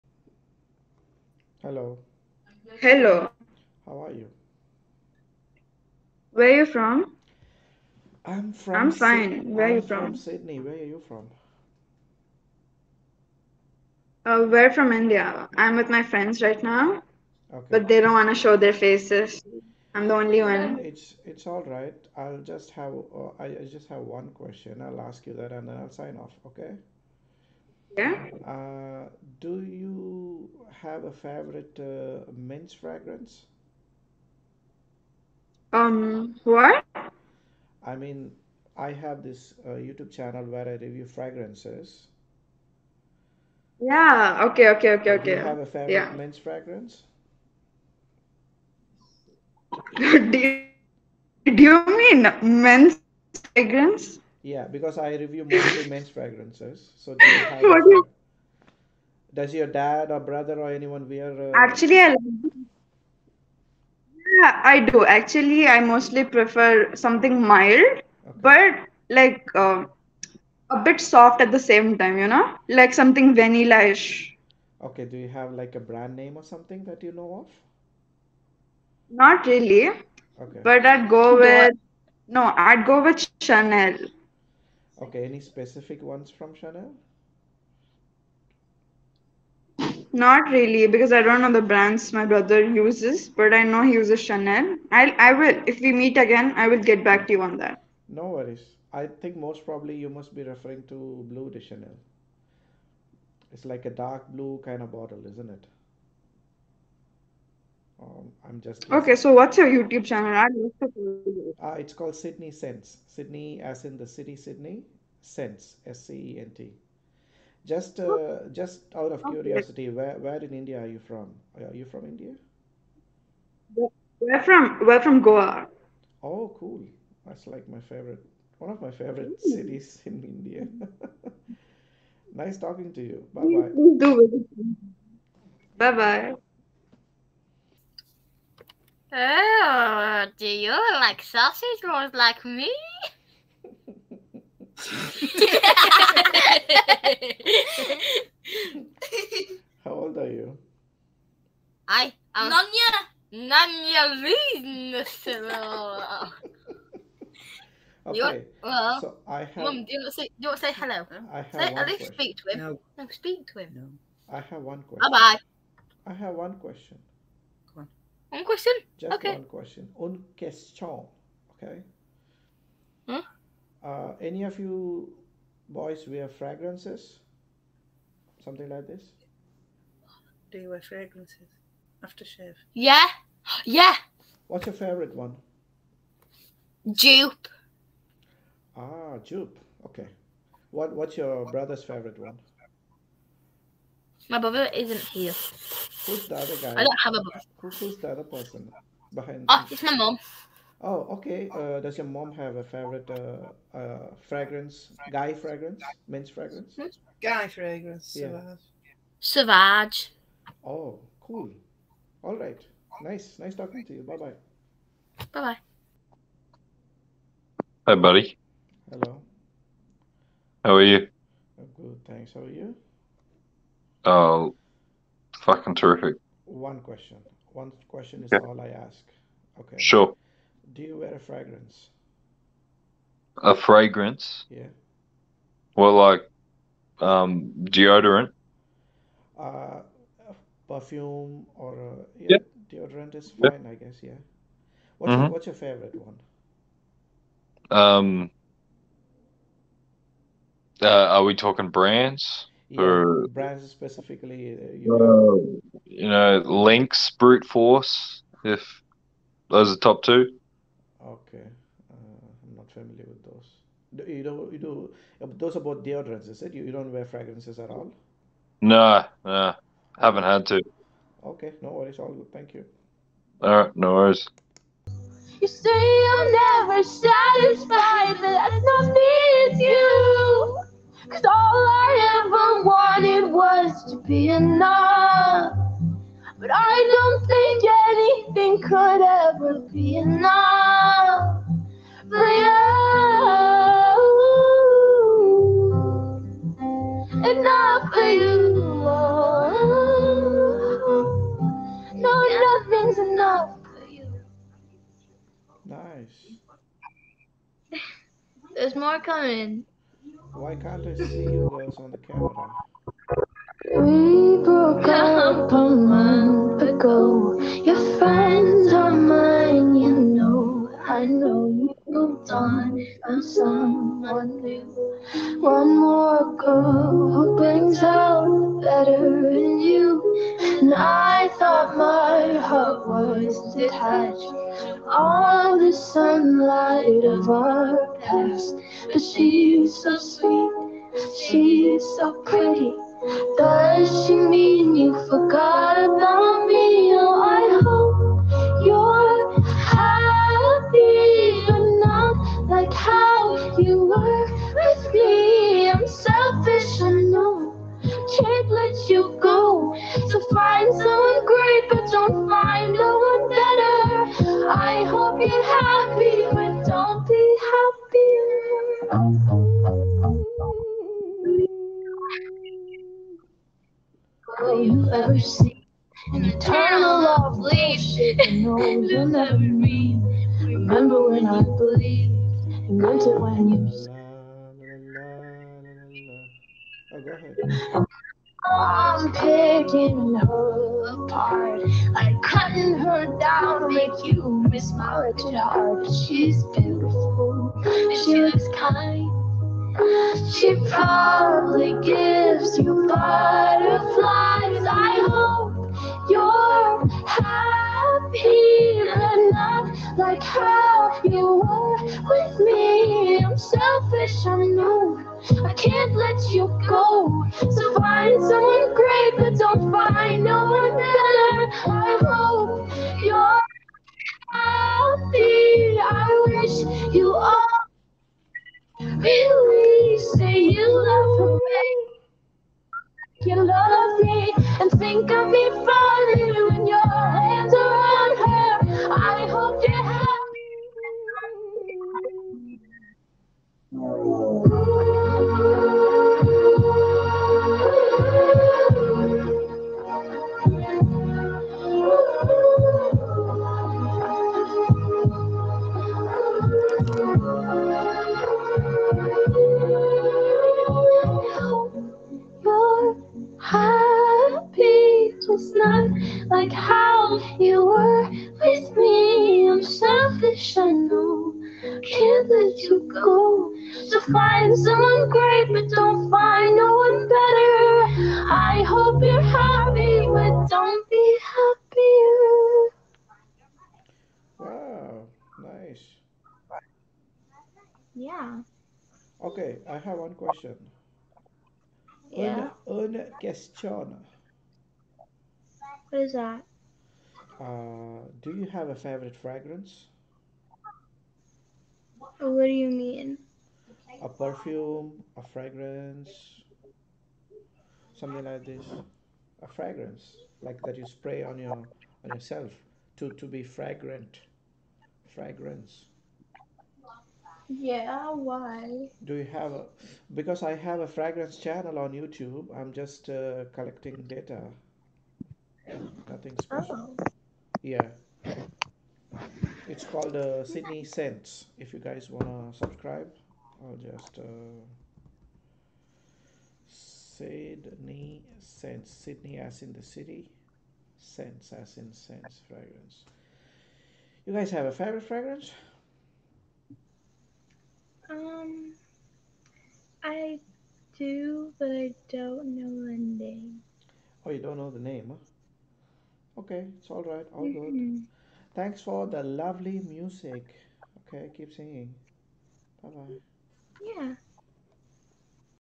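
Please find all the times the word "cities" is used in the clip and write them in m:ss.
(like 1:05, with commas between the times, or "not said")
2:09.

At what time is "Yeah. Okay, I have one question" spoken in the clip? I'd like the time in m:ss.
8:07.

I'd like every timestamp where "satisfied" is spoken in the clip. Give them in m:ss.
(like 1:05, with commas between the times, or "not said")
4:36.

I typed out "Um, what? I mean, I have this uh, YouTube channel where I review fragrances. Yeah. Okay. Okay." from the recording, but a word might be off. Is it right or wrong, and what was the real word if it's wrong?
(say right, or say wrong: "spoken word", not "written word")
right.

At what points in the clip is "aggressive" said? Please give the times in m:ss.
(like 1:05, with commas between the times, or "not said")
not said.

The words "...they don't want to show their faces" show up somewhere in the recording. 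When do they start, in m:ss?
0:17.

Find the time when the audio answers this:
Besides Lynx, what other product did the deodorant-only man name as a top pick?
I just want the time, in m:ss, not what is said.
4:17.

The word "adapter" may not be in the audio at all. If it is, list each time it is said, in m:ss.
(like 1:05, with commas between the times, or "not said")
not said.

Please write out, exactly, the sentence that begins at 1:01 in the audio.
Uh, Actually, I like yeah, I do.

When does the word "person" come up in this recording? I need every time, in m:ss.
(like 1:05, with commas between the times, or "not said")
3:18.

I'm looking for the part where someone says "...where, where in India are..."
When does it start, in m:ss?
1:59.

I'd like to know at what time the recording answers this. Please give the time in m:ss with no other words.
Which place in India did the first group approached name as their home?
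2:05.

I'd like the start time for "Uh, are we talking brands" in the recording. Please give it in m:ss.
4:10.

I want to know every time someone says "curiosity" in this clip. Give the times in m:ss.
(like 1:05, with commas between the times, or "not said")
1:59.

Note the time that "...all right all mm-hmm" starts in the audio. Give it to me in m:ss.
9:16.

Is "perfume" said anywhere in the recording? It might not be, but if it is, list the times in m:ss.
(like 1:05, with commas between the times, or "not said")
4:00, 8:24.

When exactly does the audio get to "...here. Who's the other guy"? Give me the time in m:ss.
3:14.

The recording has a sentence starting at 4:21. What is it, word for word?
Okay, uh, I'm not familiar with those.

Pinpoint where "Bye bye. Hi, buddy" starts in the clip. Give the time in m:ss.
3:35.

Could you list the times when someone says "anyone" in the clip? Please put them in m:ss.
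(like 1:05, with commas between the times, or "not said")
1:00.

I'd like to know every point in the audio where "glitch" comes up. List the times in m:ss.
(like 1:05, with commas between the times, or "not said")
not said.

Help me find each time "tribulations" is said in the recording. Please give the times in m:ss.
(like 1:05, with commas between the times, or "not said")
not said.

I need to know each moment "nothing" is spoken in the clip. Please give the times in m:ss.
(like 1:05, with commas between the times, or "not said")
5:02, 8:46.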